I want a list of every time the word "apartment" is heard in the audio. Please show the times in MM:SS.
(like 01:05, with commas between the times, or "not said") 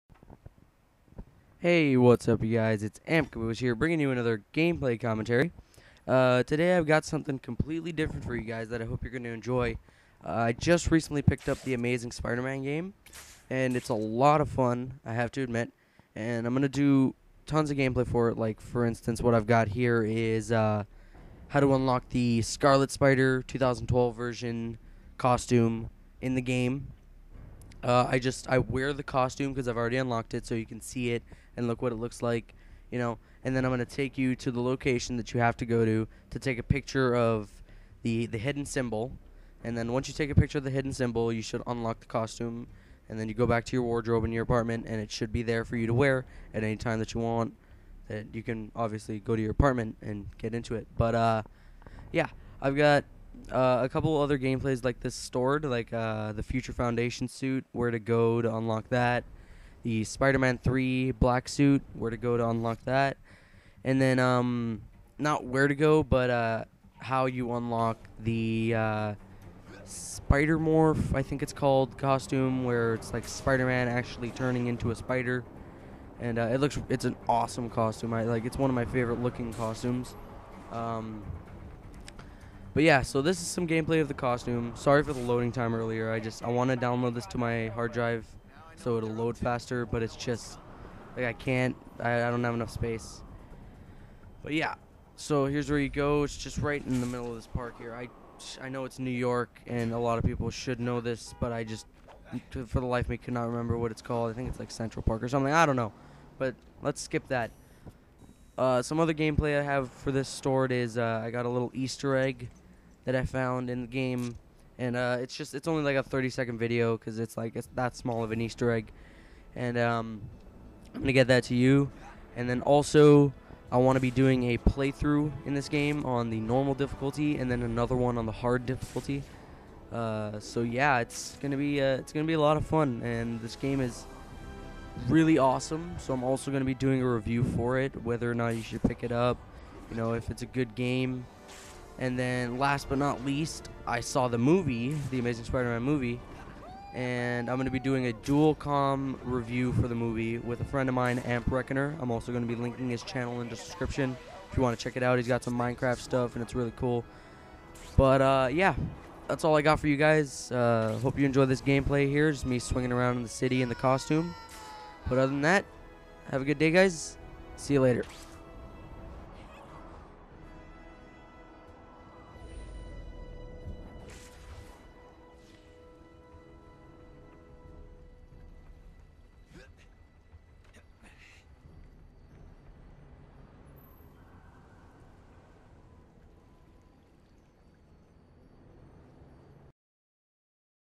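00:44, 00:49.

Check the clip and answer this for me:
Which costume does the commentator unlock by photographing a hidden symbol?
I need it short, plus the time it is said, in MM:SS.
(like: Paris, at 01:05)
Scarlet Spider 2012, at 00:22.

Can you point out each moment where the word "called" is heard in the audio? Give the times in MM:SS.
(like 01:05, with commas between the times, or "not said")
01:11, 01:44.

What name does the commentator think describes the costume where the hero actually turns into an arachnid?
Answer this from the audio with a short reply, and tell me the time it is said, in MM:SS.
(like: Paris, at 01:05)
Spider Morph, at 01:09.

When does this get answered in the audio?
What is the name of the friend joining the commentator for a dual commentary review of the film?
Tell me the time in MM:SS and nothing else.
02:31.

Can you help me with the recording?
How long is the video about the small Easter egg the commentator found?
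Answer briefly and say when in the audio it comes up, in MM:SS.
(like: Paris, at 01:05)
30 seconds, at 01:56.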